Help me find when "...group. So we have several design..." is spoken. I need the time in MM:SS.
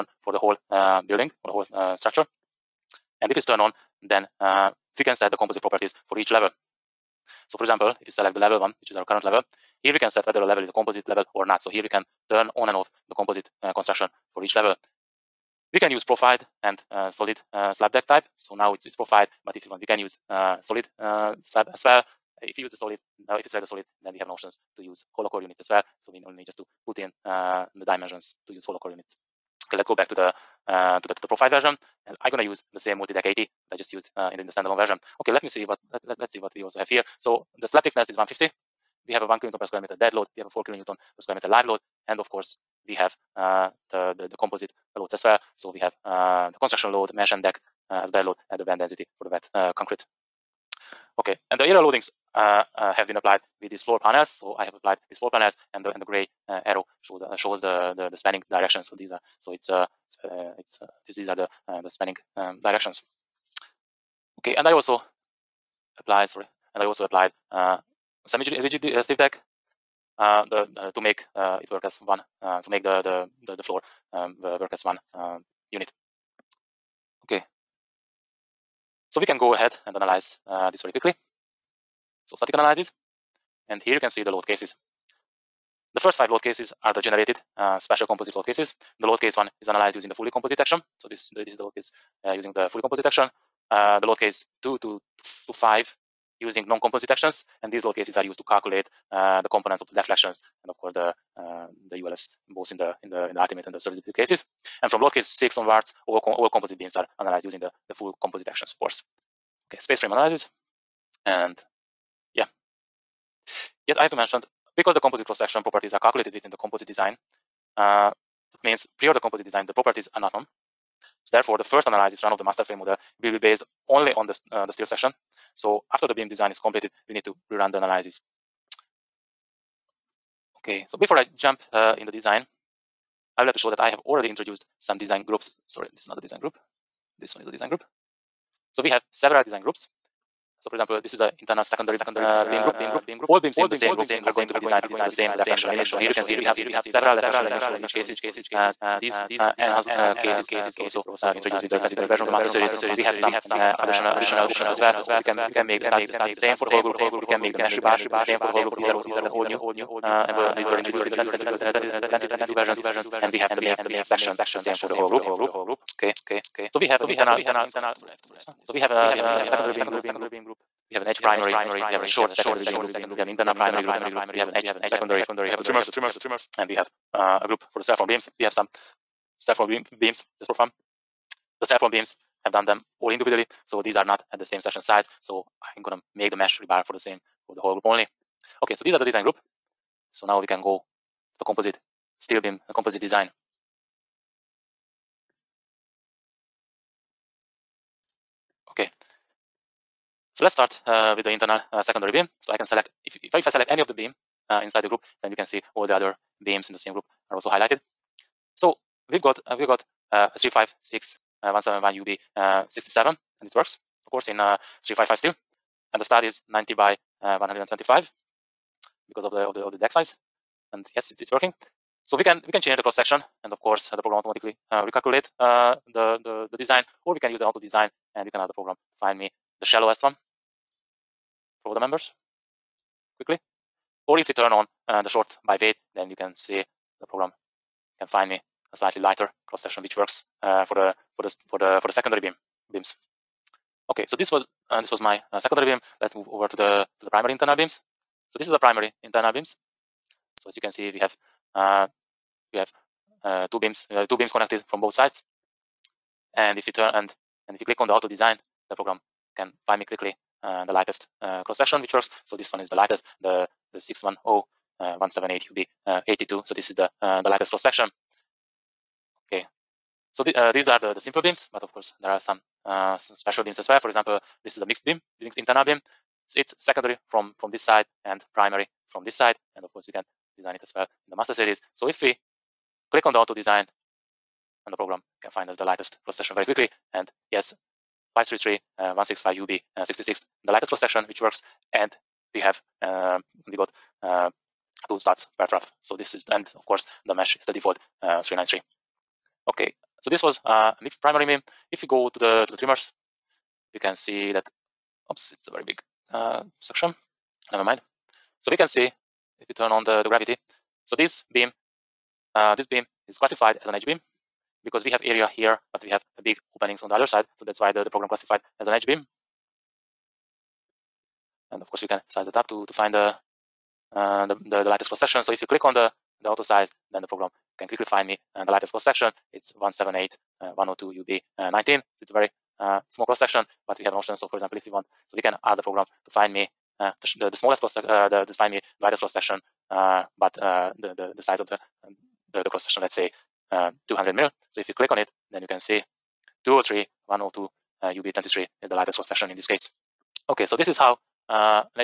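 02:17.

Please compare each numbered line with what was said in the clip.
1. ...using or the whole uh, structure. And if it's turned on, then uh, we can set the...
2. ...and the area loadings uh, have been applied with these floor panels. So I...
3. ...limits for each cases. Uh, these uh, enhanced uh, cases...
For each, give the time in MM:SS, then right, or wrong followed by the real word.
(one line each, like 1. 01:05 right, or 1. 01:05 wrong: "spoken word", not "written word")
1. 00:01 wrong: "building", not "using"
2. 00:51 right
3. 02:27 right.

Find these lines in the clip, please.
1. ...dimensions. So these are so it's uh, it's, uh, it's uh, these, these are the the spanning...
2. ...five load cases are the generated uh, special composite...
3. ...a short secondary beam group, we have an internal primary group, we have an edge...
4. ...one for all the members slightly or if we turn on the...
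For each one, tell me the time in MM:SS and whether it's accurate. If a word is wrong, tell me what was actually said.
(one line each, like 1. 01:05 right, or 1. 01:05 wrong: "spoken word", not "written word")
1. 00:58 wrong: "directions", not "dimensions"
2. 01:26 right
3. 02:51 right
4. 03:50 wrong: "quickly", not "slightly".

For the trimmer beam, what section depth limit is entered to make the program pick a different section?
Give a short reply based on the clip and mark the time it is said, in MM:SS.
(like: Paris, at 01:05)
200 mm, at 05:43.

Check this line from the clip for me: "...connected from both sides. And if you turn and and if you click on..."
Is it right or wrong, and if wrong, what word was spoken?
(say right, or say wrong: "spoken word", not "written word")
right.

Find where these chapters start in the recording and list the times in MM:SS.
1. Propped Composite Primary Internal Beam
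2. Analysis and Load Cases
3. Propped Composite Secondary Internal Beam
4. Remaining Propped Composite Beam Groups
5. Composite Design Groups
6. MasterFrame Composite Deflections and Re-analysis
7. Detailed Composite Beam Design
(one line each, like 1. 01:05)
1. 04:08
2. 01:24
3. 03:18
4. 04:35
5. 02:17
6. 01:52
7. 03:12.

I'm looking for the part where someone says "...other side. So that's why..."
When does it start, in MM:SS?
05:16.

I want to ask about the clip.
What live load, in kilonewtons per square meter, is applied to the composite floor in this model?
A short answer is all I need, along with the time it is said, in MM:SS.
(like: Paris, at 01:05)
4, at 00:40.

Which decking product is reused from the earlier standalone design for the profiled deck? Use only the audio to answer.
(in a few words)
Multi-deck 80.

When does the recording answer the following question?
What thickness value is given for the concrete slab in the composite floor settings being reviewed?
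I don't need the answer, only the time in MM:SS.
00:38.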